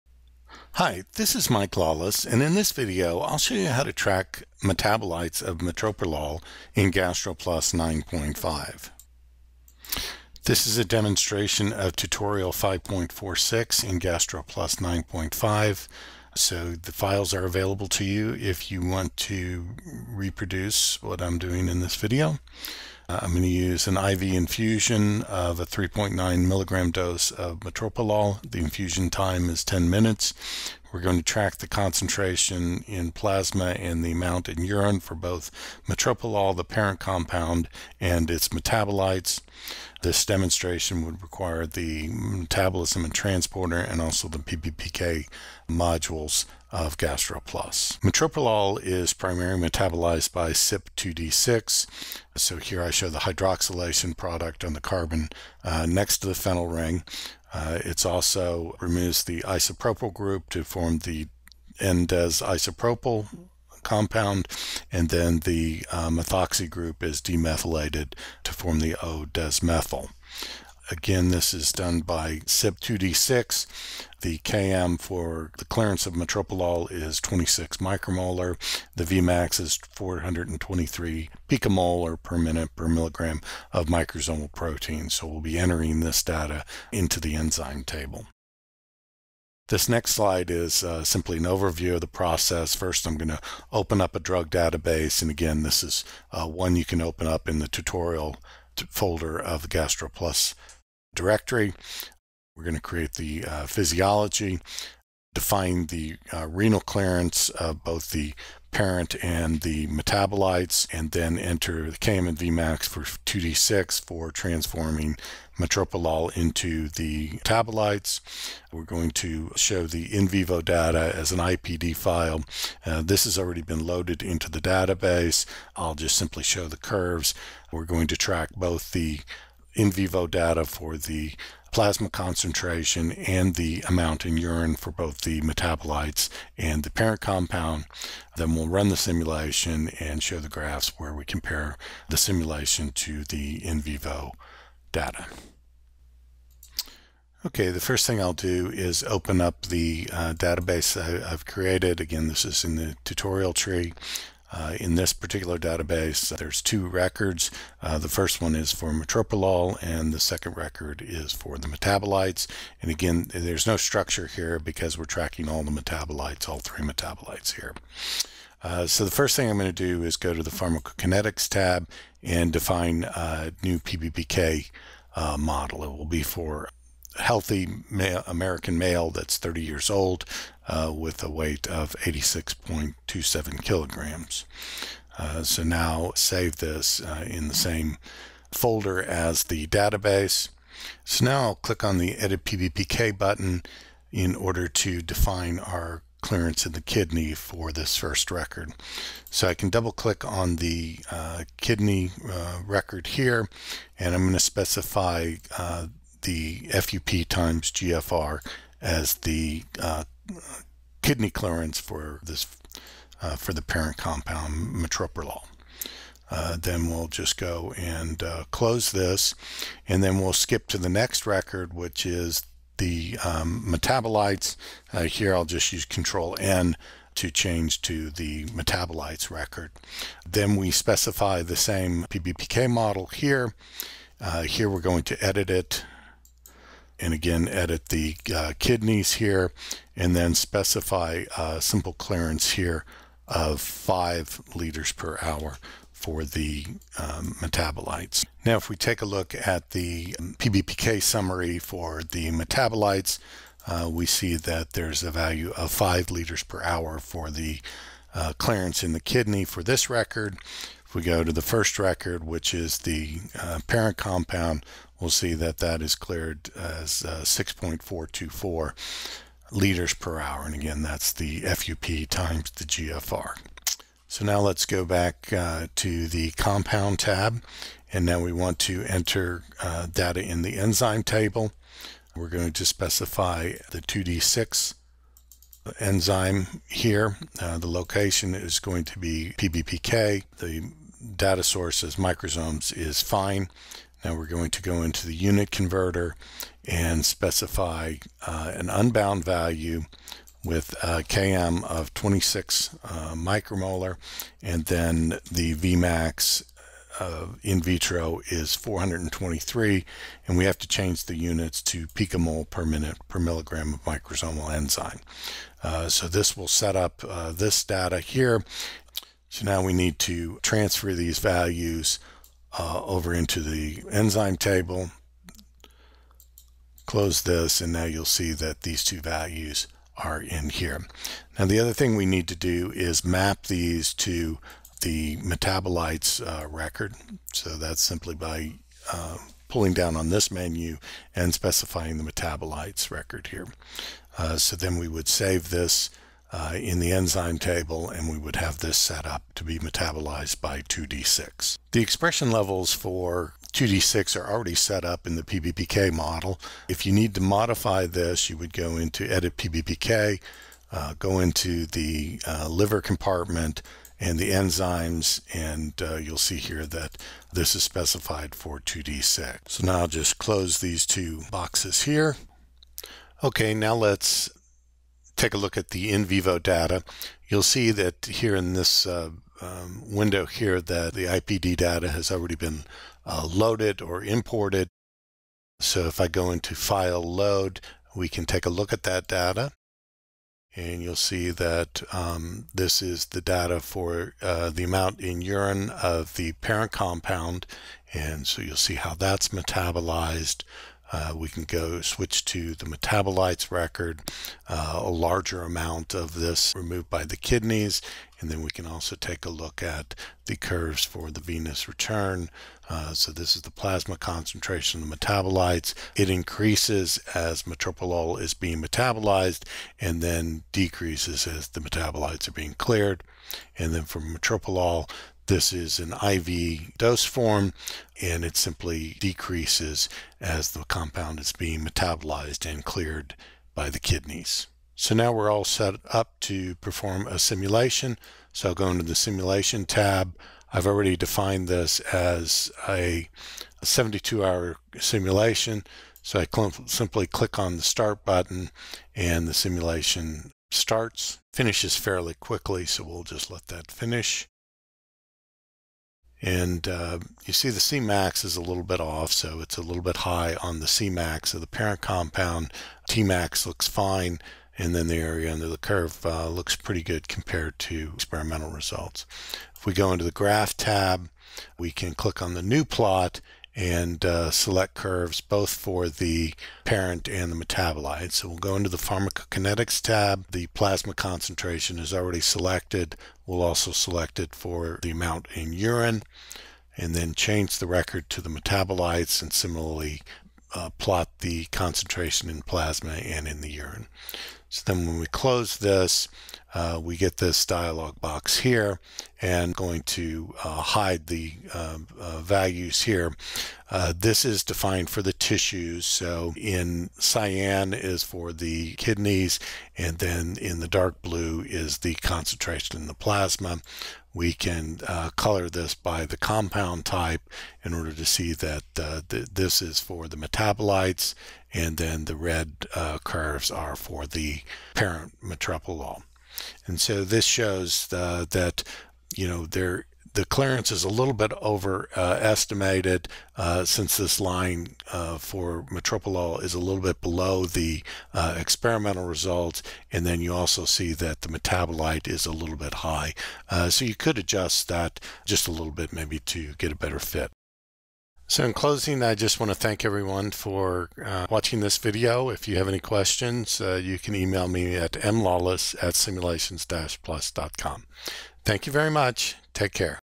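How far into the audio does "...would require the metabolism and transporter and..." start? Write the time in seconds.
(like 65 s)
41 s.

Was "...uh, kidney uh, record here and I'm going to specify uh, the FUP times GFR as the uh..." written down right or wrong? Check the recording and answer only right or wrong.
right.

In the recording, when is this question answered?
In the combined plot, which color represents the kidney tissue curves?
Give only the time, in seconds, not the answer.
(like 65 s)
506 s.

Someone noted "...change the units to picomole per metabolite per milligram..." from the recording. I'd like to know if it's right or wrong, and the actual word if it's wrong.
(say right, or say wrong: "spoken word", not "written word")
wrong: "minute", not "metabolite".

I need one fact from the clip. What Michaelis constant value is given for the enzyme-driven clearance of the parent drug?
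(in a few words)
26 micromolar.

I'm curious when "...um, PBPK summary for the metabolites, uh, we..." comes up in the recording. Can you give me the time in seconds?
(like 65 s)
250 s.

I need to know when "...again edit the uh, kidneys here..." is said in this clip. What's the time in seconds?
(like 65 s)
237 s.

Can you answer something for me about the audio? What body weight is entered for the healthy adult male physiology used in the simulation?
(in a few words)
86.27 kg.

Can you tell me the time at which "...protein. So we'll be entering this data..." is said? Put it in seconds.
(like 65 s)
84 s.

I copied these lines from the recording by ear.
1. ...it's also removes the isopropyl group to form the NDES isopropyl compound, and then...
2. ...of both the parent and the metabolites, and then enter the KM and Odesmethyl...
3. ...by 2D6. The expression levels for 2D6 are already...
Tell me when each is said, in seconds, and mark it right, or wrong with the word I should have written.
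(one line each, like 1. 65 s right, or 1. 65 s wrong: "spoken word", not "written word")
1. 57 s right
2. 107 s wrong: "Vmax", not "Odesmethyl"
3. 350 s right.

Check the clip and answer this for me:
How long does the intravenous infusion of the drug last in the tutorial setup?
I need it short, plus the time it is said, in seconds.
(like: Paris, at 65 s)
10 minutes, at 29 s.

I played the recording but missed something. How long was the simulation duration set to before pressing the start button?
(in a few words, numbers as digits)
72 hours.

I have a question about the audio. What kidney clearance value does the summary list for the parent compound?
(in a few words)
6.424 L/h.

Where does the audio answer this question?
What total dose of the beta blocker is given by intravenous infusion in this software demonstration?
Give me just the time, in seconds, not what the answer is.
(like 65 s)
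25 s.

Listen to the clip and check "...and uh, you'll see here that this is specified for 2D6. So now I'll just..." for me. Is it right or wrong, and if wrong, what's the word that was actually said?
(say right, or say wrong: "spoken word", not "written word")
right.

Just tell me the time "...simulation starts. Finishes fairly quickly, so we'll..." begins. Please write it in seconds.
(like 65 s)
449 s.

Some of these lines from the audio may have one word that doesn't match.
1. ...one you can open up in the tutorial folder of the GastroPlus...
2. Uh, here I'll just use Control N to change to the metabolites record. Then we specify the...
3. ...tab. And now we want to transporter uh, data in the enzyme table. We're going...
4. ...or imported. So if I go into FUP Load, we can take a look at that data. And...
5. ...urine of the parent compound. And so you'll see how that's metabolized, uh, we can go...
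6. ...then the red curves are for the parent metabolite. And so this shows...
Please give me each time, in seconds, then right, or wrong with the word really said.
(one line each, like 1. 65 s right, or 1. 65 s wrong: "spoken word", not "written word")
1. 96 s right
2. 224 s right
3. 276 s wrong: "enter", not "transporter"
4. 383 s wrong: "File", not "FUP"
5. 395 s right
6. 521 s right.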